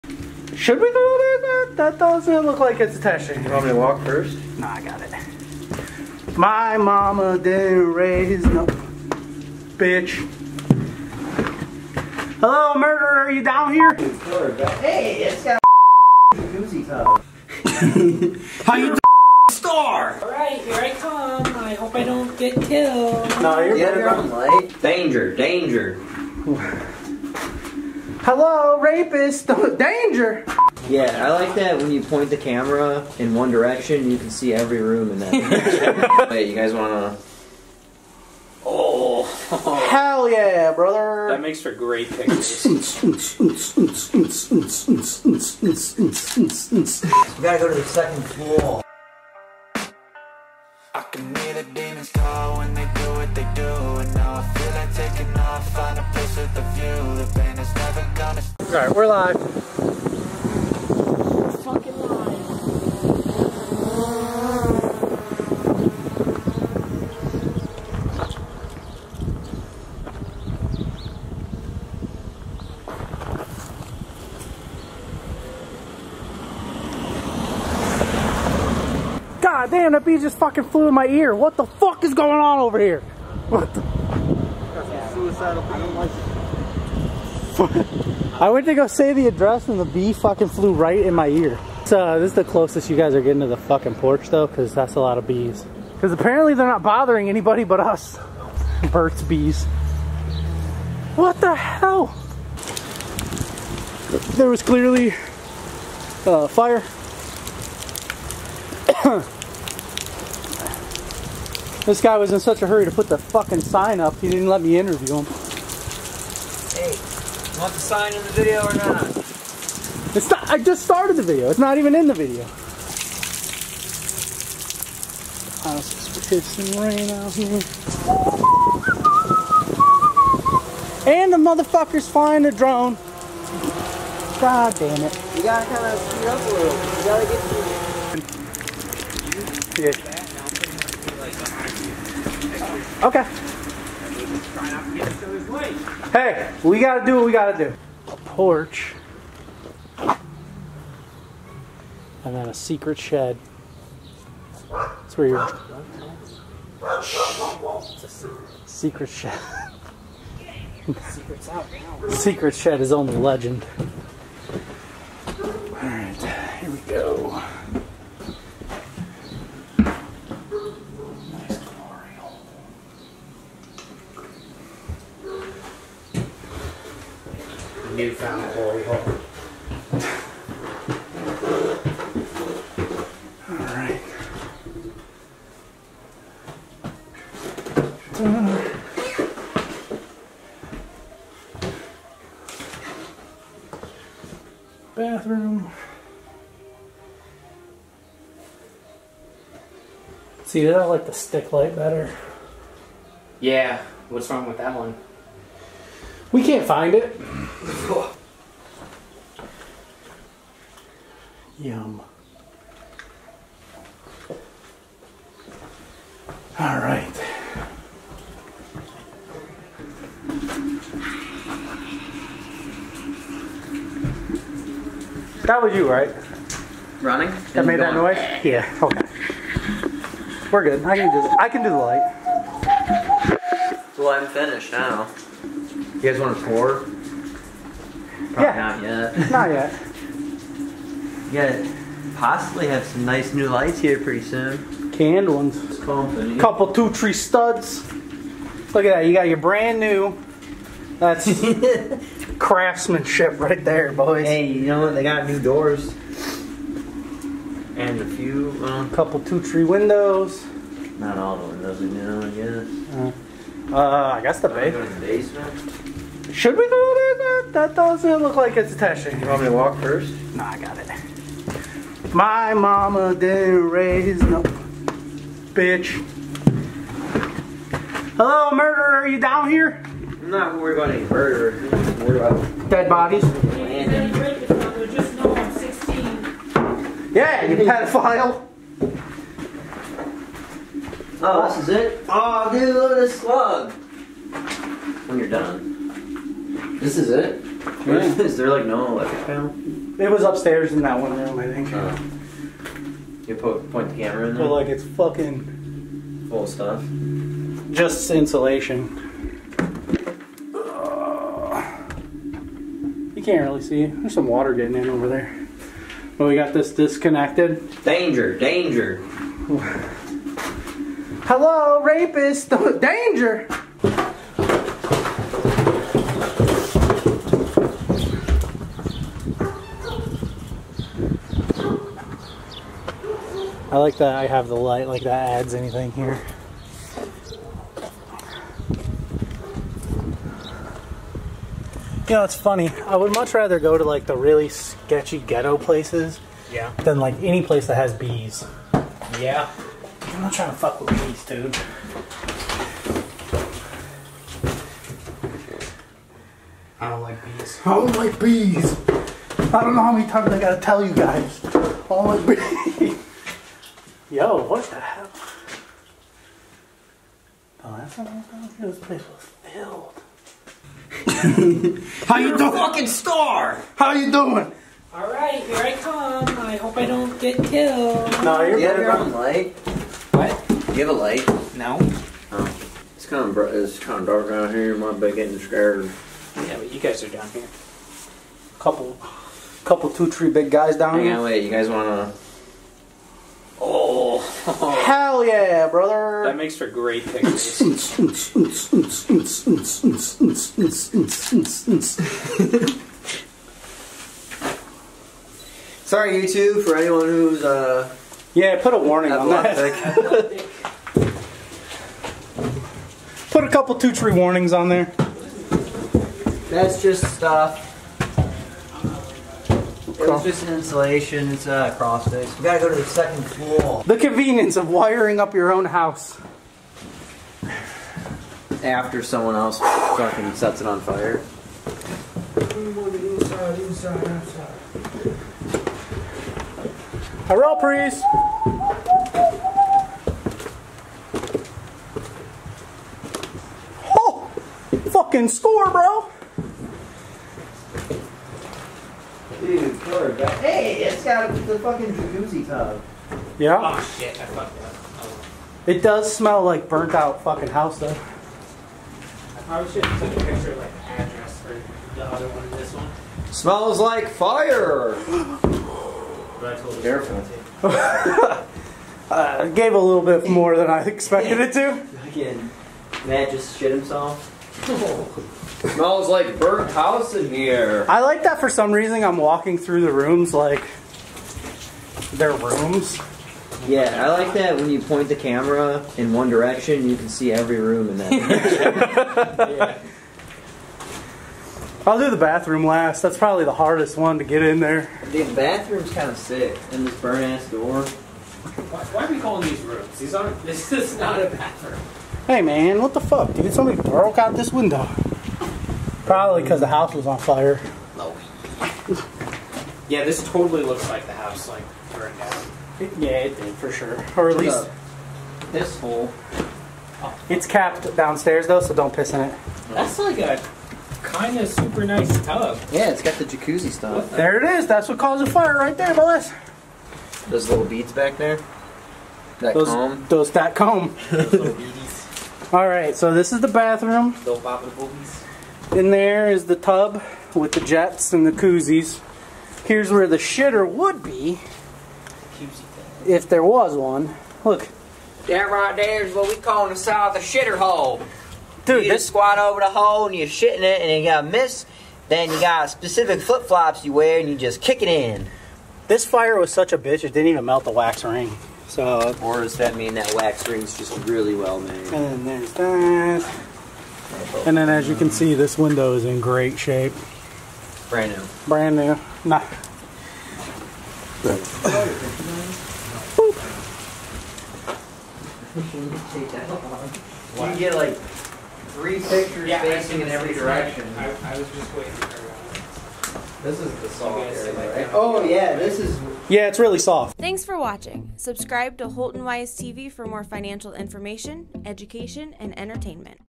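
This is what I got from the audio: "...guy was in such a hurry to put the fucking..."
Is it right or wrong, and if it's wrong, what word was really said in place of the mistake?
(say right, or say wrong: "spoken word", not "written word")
right.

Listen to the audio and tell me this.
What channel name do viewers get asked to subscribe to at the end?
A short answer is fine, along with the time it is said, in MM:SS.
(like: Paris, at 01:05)
Holton Wise TV, at 09:48.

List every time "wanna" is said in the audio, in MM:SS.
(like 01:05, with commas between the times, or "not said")
00:36, 06:31.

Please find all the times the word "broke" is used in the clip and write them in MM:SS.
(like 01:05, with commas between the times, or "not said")
08:23.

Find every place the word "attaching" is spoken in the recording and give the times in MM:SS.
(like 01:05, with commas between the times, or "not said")
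00:02, 04:28.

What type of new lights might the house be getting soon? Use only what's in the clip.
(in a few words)
Canned ones.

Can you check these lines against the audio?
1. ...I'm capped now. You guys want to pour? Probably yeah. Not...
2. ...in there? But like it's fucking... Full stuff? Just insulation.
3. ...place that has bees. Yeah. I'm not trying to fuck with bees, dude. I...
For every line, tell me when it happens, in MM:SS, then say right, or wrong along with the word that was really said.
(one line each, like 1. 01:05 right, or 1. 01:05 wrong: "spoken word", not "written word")
1. 03:54 wrong: "finished", not "capped"
2. 05:04 right
3. 05:47 right.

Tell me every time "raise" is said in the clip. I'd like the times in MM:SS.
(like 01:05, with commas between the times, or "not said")
00:07, 04:33.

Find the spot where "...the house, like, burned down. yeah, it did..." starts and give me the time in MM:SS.
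08:31.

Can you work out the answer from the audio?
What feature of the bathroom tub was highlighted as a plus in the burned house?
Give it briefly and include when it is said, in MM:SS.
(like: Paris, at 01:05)
Jacuzzi tub, at 07:31.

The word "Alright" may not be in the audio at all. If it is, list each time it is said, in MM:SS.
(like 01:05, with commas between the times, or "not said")
00:20, 08:52.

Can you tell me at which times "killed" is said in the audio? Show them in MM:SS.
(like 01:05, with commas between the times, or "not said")
00:22, 06:17.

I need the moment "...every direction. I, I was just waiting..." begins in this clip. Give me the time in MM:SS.
09:40.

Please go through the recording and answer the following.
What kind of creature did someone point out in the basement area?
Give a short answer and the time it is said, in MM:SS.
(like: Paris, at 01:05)
Slug, at 04:52.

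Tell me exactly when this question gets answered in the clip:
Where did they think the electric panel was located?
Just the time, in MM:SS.
05:00.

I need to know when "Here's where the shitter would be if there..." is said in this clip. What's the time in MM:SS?
08:59.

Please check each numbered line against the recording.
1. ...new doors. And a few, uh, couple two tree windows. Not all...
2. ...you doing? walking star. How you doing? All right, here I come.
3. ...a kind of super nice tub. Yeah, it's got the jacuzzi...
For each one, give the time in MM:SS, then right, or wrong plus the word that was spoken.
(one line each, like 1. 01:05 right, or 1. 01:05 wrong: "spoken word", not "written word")
1. 04:15 right
2. 06:12 wrong: "fucking", not "walking"
3. 08:40 right.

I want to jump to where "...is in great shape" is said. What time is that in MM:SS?
09:25.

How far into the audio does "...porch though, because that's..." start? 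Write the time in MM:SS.
01:33.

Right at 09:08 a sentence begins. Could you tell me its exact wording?
Dude, you this squat over the hole and you're shitting it and you got a miss.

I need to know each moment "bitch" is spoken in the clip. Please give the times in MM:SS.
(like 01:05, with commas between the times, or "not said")
00:08, 04:35, 09:16.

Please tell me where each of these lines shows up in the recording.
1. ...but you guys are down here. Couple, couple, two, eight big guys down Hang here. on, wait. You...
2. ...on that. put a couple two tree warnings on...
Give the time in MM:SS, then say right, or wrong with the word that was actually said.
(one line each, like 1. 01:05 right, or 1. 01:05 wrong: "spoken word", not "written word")
1. 06:26 wrong: "three", not "eight"
2. 06:49 right.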